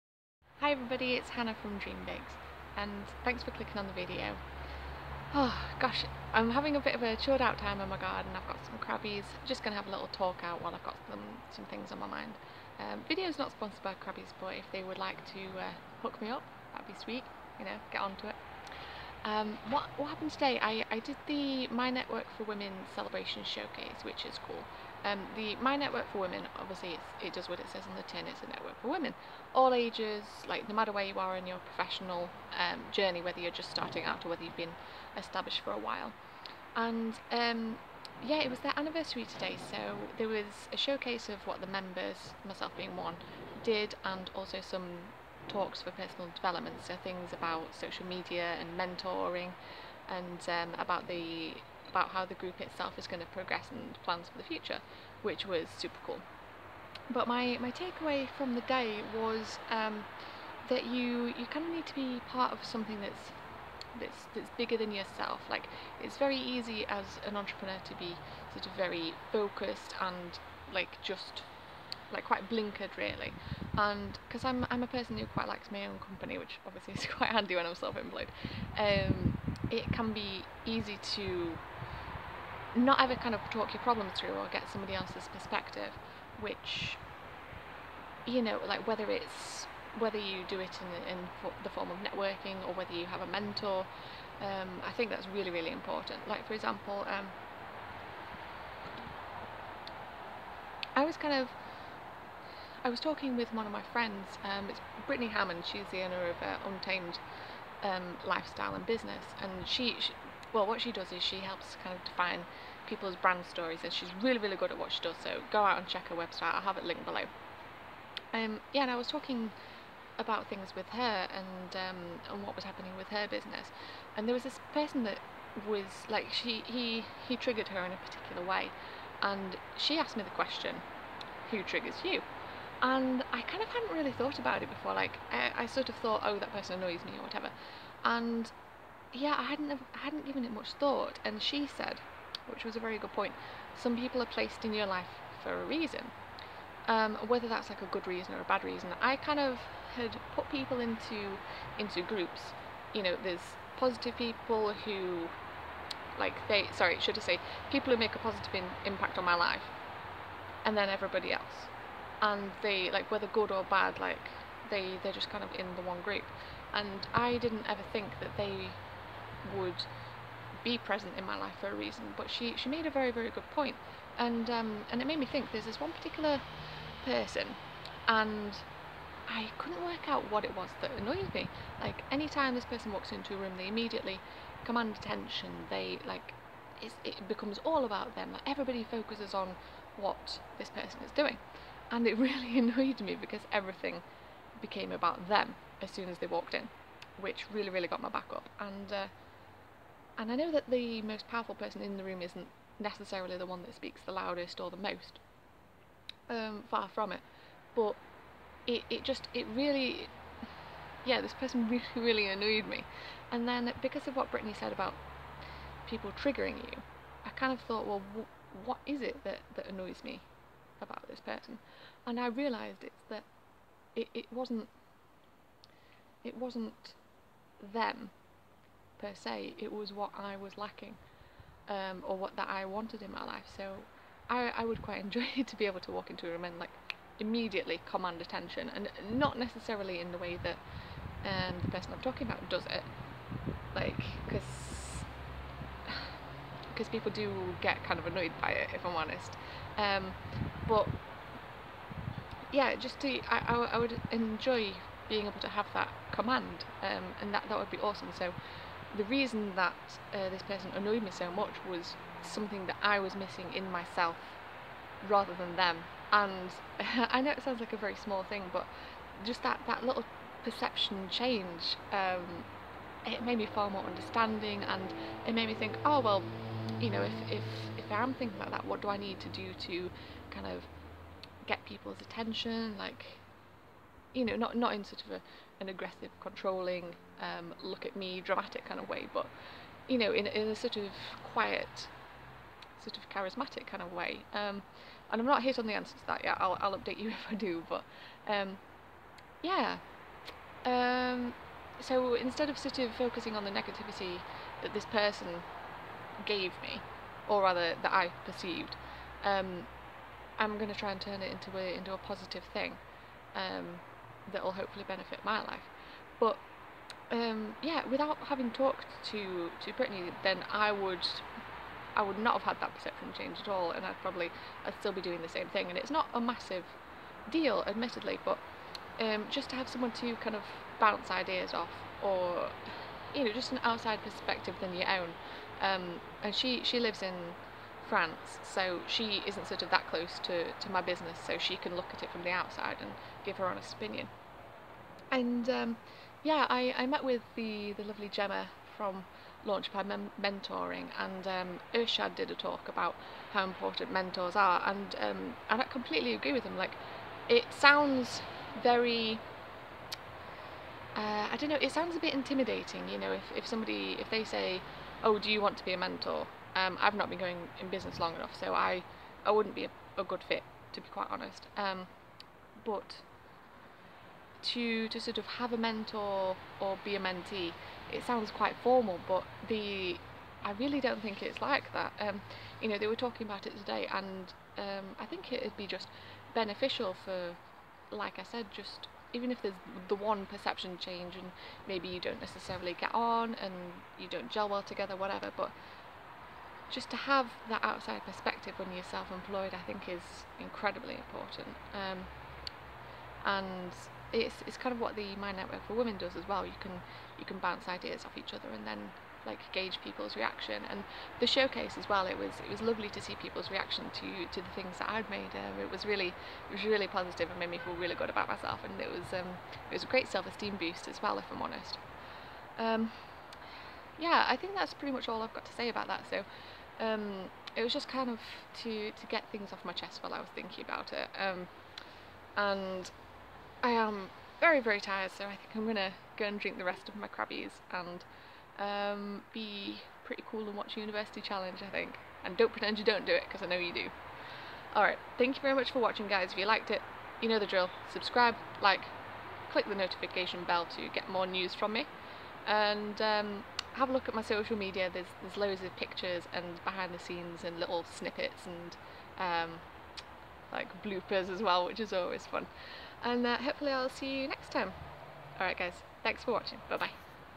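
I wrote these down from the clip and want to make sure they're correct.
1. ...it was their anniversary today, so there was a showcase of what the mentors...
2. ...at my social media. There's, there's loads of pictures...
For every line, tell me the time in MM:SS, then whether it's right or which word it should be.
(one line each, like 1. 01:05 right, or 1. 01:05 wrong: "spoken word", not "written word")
1. 00:38 wrong: "members", not "mentors"
2. 07:34 right.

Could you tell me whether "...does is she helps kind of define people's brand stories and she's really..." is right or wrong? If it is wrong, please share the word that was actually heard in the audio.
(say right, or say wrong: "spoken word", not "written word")
right.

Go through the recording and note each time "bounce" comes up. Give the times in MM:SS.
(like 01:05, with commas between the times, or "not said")
05:30, 06:47.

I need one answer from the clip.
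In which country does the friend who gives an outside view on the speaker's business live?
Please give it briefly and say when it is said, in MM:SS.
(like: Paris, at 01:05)
France, at 05:37.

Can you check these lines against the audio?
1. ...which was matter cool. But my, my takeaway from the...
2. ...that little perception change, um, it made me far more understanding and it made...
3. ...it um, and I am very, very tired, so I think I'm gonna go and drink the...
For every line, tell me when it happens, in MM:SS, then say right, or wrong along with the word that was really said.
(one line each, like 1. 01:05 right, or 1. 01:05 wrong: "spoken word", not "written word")
1. 00:55 wrong: "super", not "matter"
2. 04:29 right
3. 07:10 right.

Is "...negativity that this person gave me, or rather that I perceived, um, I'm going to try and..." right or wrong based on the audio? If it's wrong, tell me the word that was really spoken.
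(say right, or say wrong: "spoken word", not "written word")
right.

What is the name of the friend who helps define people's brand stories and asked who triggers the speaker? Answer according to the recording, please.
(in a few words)
Brittany Hammond.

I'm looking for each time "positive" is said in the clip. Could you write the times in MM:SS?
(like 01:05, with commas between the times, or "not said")
02:33, 02:38, 05:11, 06:56.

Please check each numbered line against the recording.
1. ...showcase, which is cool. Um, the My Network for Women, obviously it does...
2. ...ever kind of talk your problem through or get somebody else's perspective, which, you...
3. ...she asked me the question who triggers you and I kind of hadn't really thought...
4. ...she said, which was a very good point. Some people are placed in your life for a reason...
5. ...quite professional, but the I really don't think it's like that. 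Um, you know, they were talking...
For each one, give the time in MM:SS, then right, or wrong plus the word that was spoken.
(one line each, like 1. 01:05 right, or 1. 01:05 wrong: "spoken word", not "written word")
1. 00:23 right
2. 01:23 right
3. 02:09 right
4. 02:21 right
5. 06:18 wrong: "formal", not "professional".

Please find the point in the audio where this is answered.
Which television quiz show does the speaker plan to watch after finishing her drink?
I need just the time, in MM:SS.
07:20.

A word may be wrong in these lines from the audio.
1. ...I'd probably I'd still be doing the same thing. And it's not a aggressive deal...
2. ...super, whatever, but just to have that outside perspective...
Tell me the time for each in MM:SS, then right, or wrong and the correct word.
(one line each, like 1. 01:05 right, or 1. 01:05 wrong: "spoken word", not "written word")
1. 05:23 wrong: "massive", not "aggressive"
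2. 06:34 wrong: "together", not "super".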